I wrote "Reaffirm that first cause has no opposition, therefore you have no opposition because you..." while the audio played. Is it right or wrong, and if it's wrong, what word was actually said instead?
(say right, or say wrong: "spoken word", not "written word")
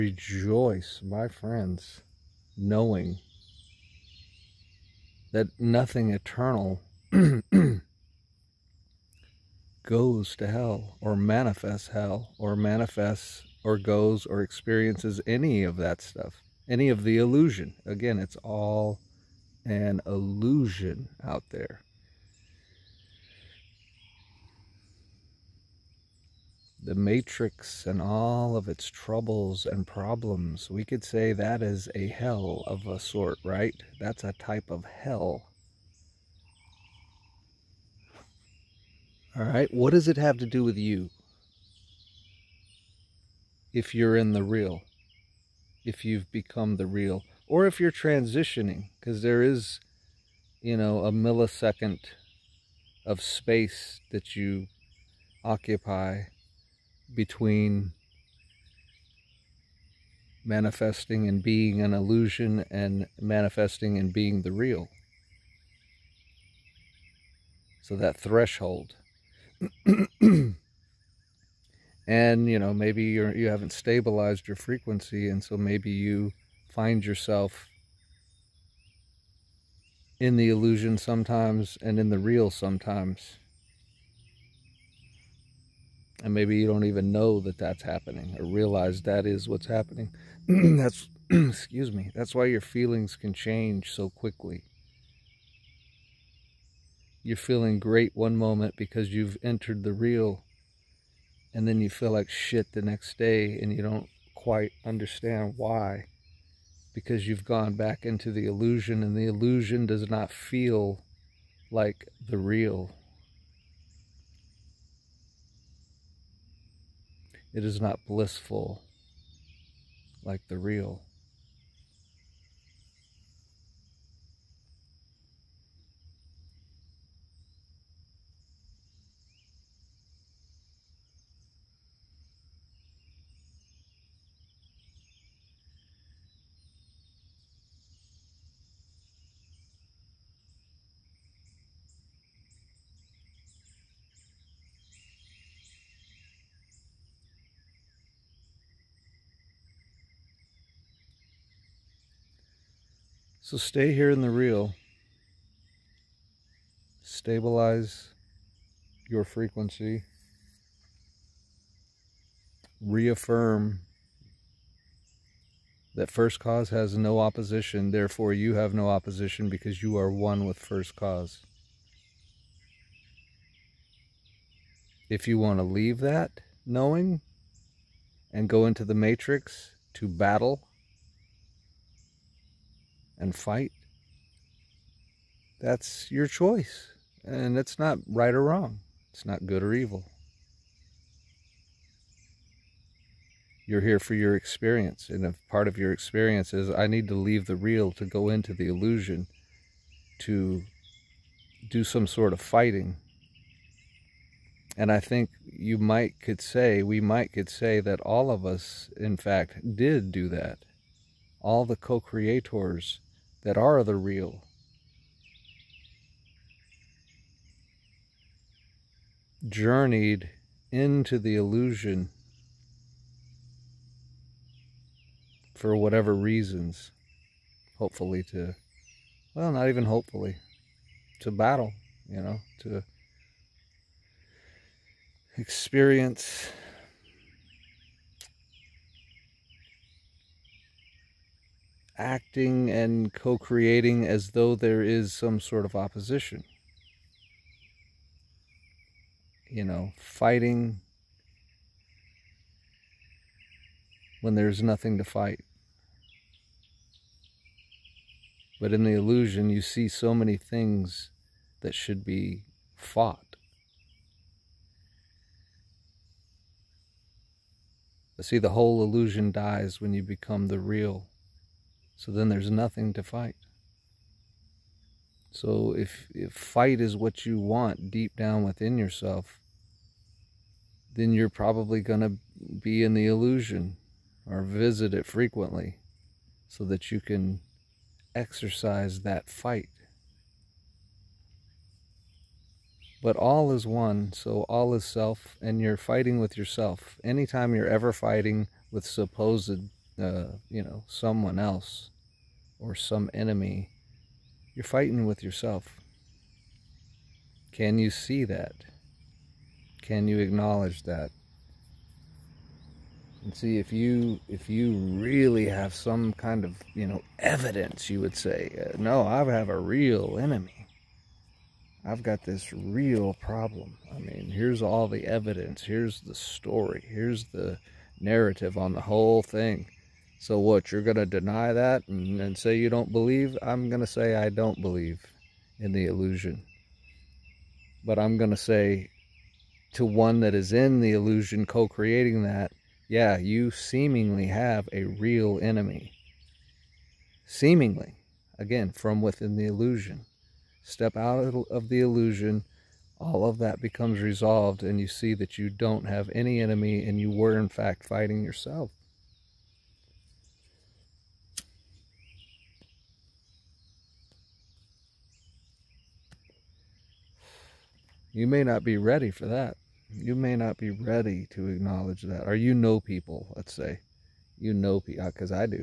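right.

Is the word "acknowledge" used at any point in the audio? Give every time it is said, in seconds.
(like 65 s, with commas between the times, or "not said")
310 s, 371 s.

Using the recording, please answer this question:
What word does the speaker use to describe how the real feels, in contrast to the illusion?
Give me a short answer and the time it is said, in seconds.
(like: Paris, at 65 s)
Blissful, at 118 s.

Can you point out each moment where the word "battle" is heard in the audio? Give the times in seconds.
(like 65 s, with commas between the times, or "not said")
180 s, 231 s.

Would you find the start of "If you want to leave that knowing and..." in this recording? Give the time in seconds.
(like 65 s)
175 s.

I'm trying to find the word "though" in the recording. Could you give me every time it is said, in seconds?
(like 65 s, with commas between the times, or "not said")
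244 s.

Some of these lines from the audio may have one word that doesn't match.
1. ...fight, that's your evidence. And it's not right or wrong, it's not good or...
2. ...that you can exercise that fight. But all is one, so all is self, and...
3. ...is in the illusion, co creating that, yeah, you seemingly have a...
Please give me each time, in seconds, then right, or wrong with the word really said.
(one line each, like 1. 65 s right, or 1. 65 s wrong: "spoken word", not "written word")
1. 183 s wrong: "choice", not "evidence"
2. 286 s right
3. 340 s right.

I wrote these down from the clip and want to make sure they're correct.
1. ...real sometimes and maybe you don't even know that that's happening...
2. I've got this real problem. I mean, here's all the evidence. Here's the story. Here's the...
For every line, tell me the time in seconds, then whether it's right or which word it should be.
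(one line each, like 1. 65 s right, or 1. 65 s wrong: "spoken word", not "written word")
1. 82 s right
2. 321 s right.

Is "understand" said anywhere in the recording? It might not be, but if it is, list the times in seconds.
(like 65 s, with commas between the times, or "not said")
104 s.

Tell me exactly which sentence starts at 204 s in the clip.
And I think you might could say, we might could say that all of us, in fact, did do that.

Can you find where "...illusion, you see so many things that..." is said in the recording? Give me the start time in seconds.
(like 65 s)
258 s.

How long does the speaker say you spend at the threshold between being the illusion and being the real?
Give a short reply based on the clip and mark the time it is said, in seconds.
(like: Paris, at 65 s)
A millisecond, at 51 s.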